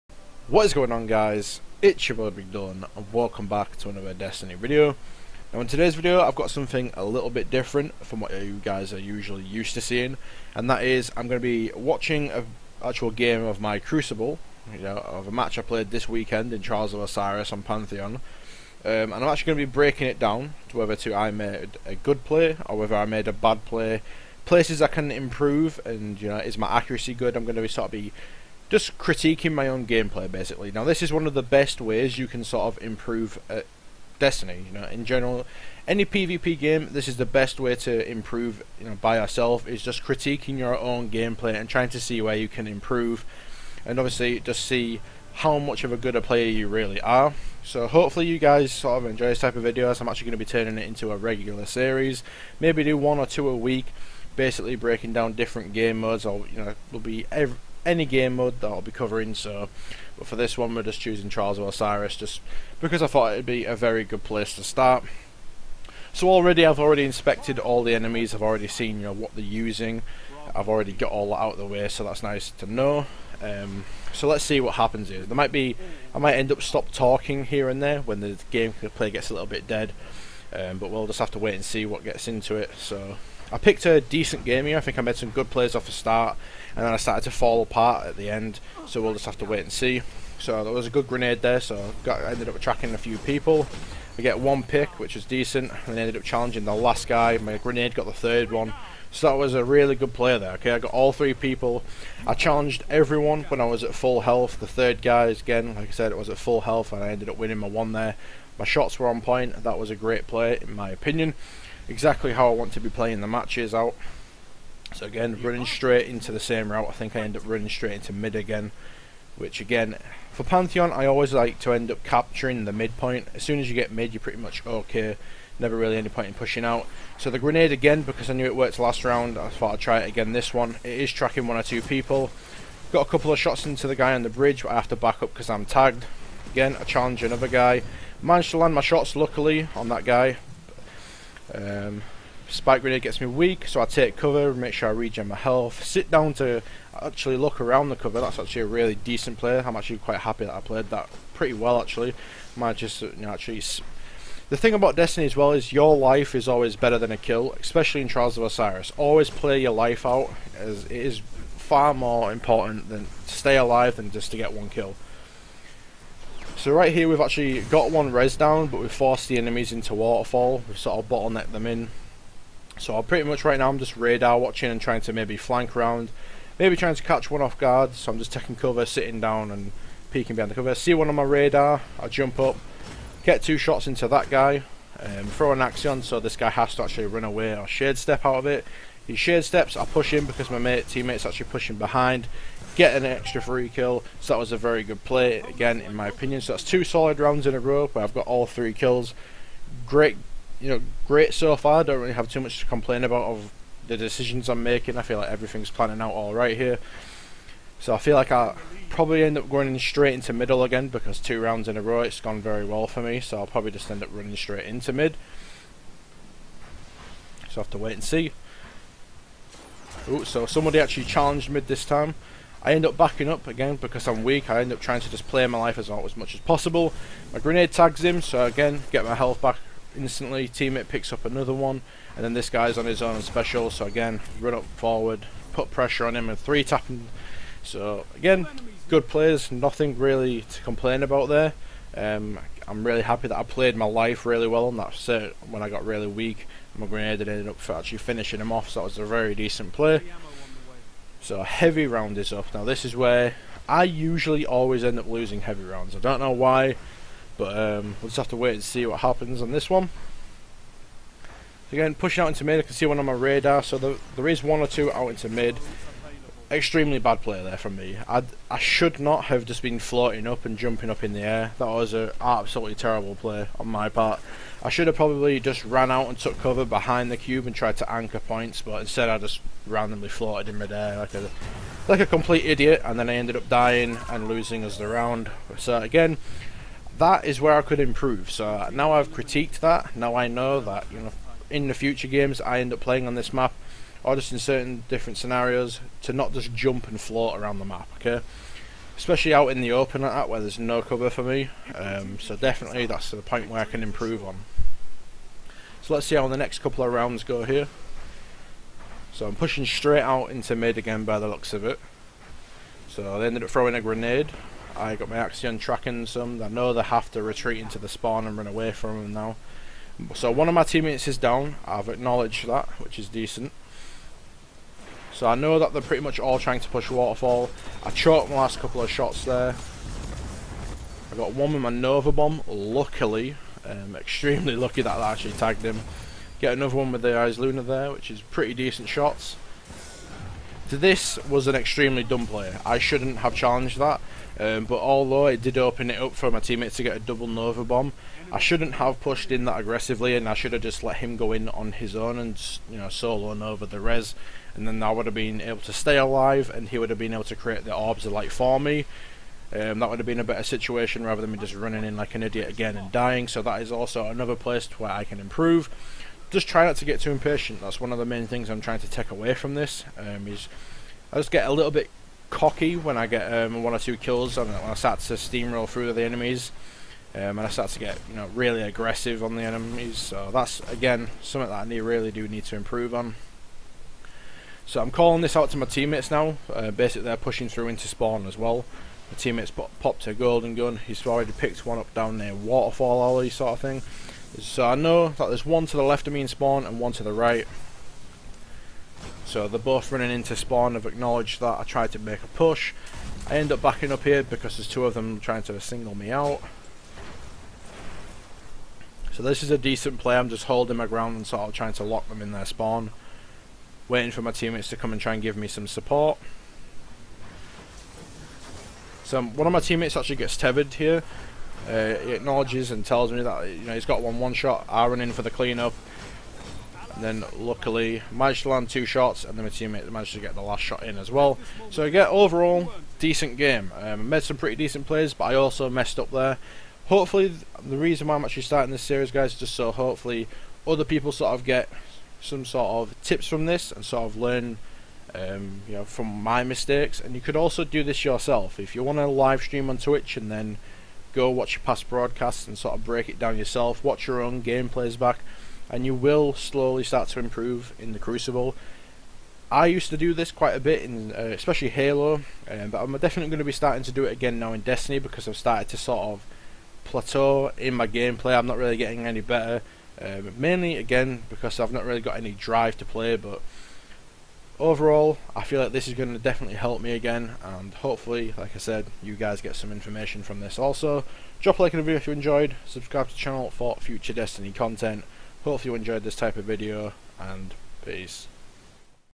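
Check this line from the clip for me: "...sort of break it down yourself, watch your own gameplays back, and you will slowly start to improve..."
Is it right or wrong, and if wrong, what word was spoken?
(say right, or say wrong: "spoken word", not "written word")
right.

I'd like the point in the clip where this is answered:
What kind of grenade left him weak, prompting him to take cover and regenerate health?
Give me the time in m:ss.
2:22.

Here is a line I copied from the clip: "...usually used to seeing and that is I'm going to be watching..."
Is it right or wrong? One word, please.
right.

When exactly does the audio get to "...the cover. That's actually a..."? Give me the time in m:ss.
2:27.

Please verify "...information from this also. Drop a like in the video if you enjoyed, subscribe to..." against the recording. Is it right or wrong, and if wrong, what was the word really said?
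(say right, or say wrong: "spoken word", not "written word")
right.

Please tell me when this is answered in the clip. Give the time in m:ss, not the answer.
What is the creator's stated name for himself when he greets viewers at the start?
0:02.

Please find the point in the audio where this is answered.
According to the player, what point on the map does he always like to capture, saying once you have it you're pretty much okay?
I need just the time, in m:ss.
2:02.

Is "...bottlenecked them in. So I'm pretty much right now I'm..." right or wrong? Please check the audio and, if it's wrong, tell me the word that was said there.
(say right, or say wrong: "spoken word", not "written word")
right.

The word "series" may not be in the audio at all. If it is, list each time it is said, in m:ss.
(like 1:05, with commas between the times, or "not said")
0:51, 7:18.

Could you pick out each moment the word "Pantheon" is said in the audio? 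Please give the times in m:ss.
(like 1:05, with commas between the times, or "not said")
0:17, 2:00.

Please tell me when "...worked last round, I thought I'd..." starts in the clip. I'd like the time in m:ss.
2:08.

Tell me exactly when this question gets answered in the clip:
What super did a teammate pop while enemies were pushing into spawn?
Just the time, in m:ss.
6:30.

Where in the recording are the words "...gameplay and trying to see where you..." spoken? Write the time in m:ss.
0:41.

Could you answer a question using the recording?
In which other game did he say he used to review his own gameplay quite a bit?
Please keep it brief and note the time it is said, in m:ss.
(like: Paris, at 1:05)
Halo, at 7:41.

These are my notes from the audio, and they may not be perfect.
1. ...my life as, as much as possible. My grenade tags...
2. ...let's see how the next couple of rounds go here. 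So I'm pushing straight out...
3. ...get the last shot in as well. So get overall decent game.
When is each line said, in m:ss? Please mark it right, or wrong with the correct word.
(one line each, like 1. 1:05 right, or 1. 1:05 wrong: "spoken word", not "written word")
1. 3:45 right
2. 5:05 right
3. 7:10 right.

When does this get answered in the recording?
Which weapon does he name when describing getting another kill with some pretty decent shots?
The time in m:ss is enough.
5:37.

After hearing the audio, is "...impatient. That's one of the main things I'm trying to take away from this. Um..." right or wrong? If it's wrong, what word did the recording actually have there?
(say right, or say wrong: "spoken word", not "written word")
right.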